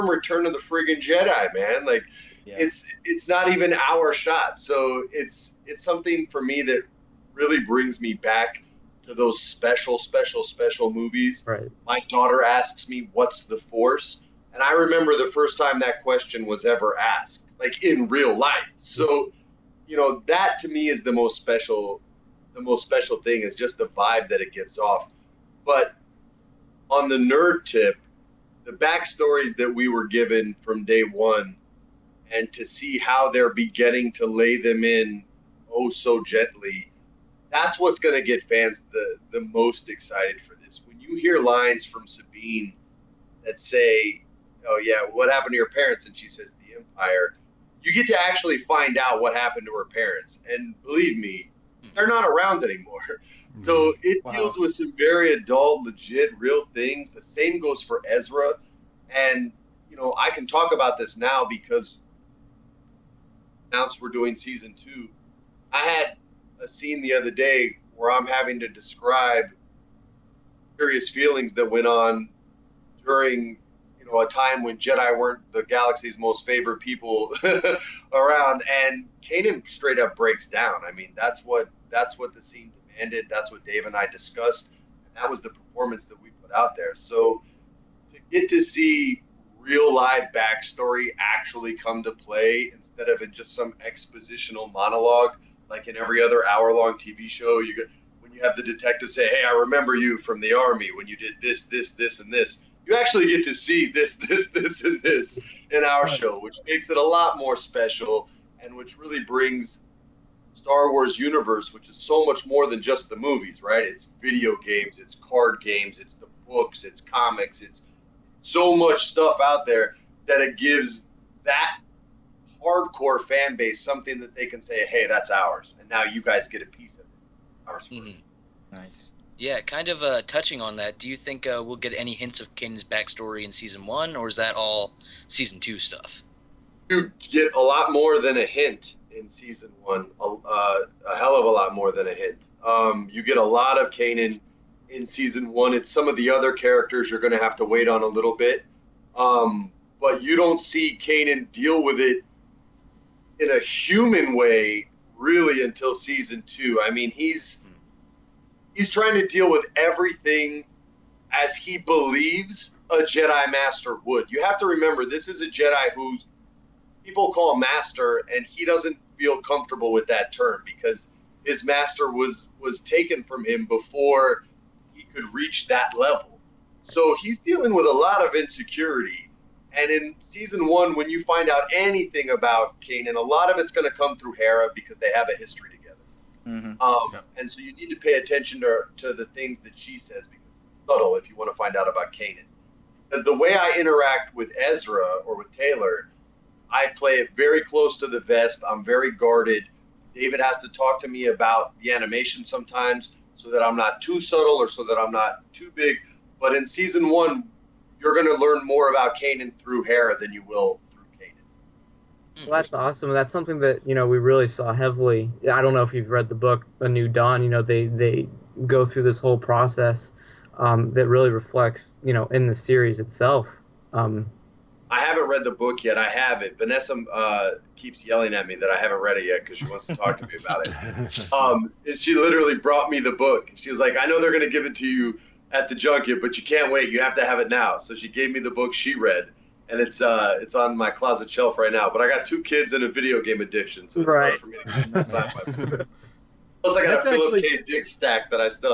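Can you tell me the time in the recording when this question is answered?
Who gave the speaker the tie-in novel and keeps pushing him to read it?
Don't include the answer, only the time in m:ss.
3:46.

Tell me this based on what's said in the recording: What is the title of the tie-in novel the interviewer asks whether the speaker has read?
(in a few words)
A New Dawn.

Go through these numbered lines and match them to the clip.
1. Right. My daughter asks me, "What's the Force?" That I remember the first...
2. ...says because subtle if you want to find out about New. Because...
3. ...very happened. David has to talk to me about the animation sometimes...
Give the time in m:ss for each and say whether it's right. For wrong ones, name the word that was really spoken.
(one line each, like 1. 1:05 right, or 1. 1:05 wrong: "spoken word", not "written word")
1. 0:11 wrong: "And", not "That"
2. 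3:09 wrong: "Kanan", not "New"
3. 3:18 wrong: "guarded", not "happened".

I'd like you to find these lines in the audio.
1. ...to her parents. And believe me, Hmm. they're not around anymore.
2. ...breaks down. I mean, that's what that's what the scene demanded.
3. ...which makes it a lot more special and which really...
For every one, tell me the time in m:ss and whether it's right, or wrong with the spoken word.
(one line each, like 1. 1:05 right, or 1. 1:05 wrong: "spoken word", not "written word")
1. 0:49 right
2. 1:20 right
3. 1:46 right.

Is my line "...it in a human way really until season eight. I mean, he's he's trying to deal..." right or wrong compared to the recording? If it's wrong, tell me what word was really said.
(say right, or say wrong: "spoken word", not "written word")
wrong: "two", not "eight".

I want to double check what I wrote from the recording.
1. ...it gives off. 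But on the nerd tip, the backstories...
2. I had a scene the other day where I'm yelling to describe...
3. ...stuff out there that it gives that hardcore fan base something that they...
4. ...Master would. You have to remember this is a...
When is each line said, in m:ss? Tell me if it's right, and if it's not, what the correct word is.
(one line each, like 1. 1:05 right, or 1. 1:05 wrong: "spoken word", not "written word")
1. 0:24 right
2. 1:05 wrong: "having", not "yelling"
3. 1:59 right
4. 2:43 right.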